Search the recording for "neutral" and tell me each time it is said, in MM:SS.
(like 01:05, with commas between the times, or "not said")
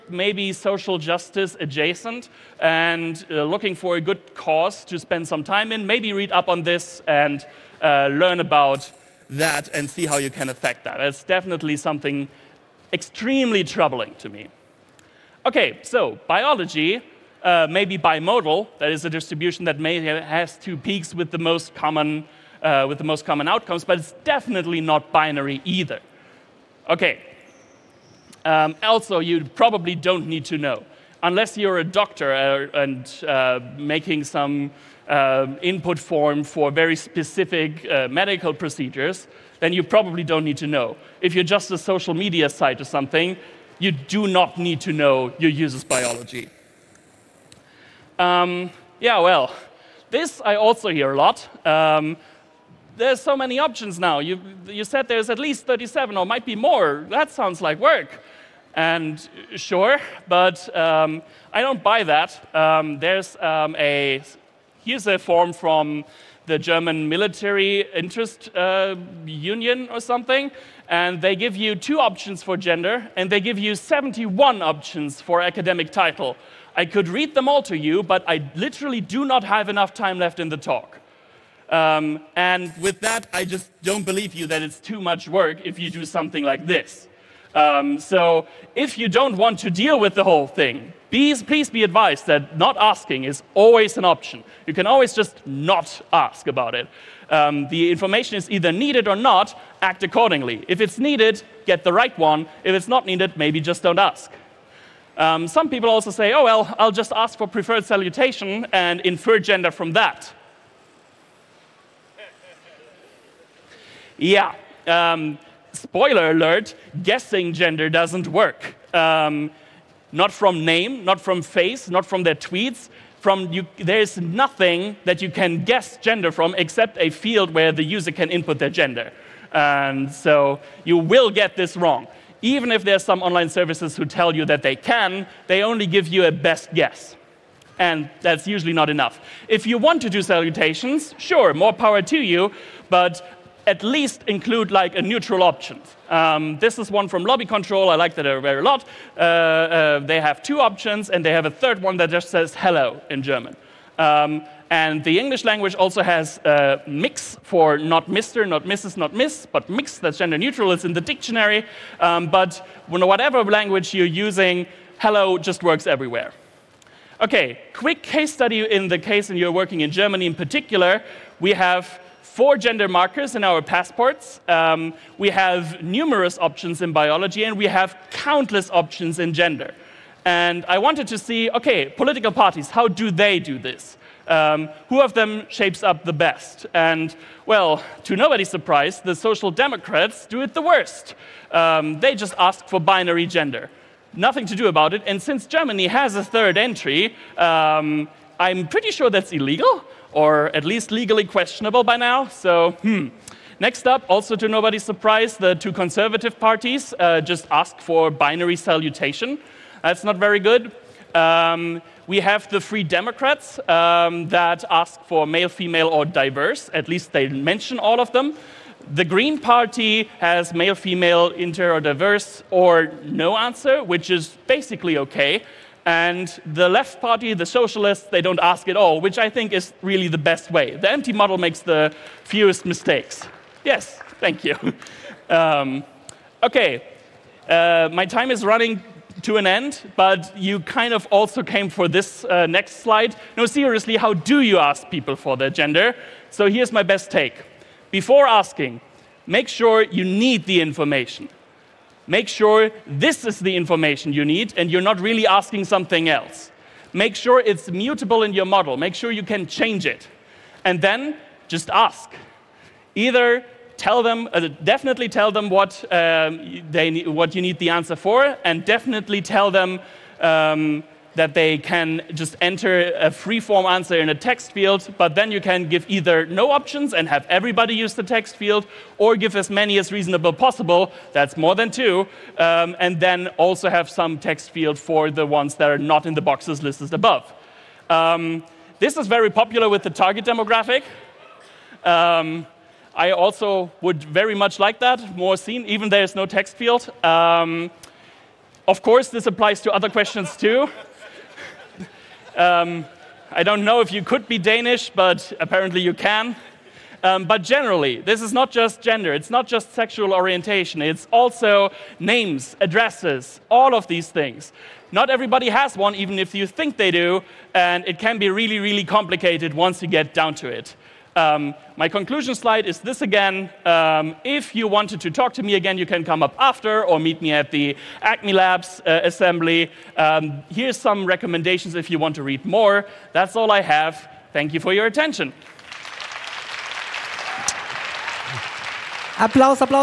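02:25, 02:40.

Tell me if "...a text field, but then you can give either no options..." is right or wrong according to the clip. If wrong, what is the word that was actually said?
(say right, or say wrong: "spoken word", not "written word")
right.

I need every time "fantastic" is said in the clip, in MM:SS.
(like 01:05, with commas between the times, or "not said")
not said.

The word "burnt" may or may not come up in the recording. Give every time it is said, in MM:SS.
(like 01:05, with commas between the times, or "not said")
not said.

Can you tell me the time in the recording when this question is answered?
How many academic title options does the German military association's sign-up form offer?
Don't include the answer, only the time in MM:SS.
01:13.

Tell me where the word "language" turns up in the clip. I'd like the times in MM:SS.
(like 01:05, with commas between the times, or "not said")
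02:35, 02:43.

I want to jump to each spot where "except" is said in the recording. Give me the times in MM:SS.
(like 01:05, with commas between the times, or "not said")
02:06.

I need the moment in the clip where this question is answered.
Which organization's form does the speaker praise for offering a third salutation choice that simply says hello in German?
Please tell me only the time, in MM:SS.
02:27.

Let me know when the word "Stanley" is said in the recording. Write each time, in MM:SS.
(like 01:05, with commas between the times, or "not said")
not said.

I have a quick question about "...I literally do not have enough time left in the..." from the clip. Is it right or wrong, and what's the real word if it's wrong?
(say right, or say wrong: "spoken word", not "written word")
right.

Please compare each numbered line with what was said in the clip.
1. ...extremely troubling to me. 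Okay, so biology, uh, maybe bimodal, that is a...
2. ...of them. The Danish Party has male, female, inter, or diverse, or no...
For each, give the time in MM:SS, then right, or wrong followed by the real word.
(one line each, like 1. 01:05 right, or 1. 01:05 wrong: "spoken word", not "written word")
1. 00:12 right
2. 03:38 wrong: "Green", not "Danish".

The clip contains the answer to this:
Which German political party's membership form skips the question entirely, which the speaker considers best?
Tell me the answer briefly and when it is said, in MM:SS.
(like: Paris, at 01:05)
The Left Party, at 03:46.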